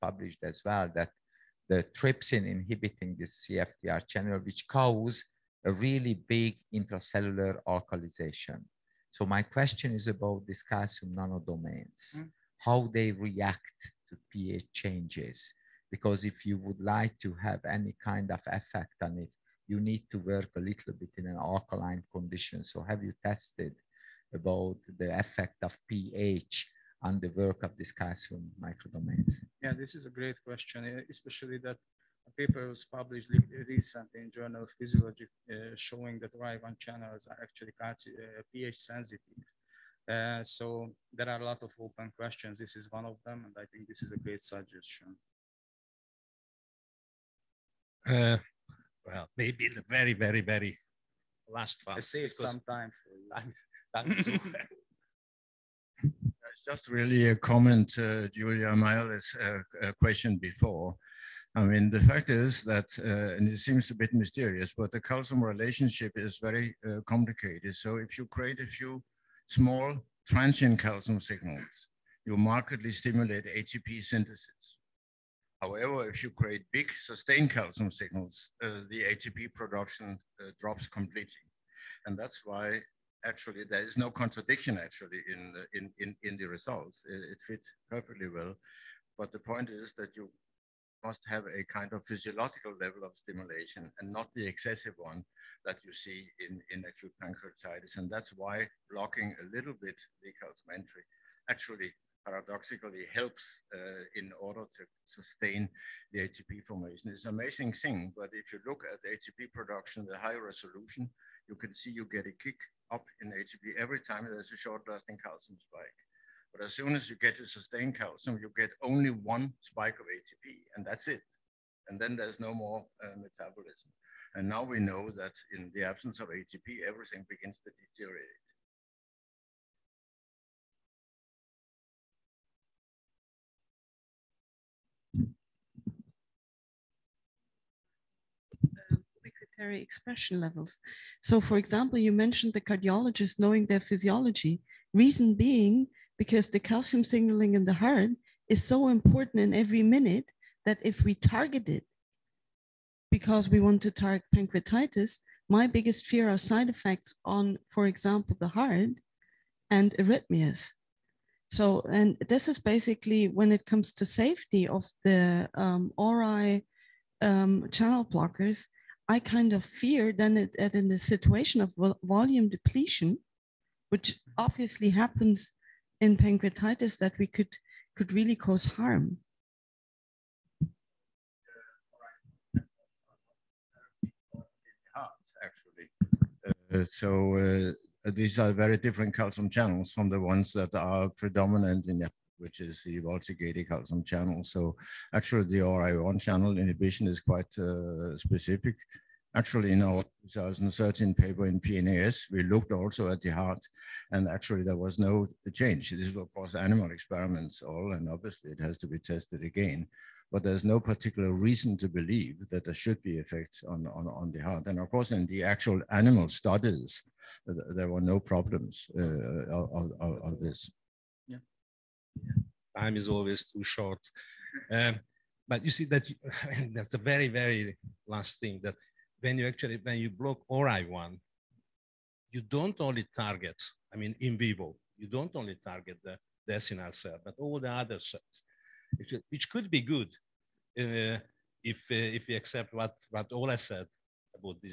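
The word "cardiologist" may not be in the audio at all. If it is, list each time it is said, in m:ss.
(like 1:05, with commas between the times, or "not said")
2:22.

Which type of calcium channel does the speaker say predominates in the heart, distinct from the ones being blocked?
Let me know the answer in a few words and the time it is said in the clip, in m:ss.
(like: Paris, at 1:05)
voltage-gated calcium channel, at 3:12.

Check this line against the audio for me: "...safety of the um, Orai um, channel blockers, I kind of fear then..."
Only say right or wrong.
right.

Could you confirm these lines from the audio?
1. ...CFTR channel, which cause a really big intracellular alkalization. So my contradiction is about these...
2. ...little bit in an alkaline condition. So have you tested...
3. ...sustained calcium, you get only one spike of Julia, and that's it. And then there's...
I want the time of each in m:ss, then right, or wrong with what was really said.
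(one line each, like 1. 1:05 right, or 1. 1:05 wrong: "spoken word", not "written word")
1. 0:03 wrong: "question", not "contradiction"
2. 0:20 right
3. 1:57 wrong: "ATP", not "Julia".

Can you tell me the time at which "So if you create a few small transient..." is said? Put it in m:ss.
1:07.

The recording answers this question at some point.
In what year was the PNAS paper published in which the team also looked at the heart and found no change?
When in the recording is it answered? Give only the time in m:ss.
3:20.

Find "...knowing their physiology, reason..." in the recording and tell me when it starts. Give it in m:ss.
2:23.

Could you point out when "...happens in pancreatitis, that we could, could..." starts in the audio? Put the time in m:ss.
2:54.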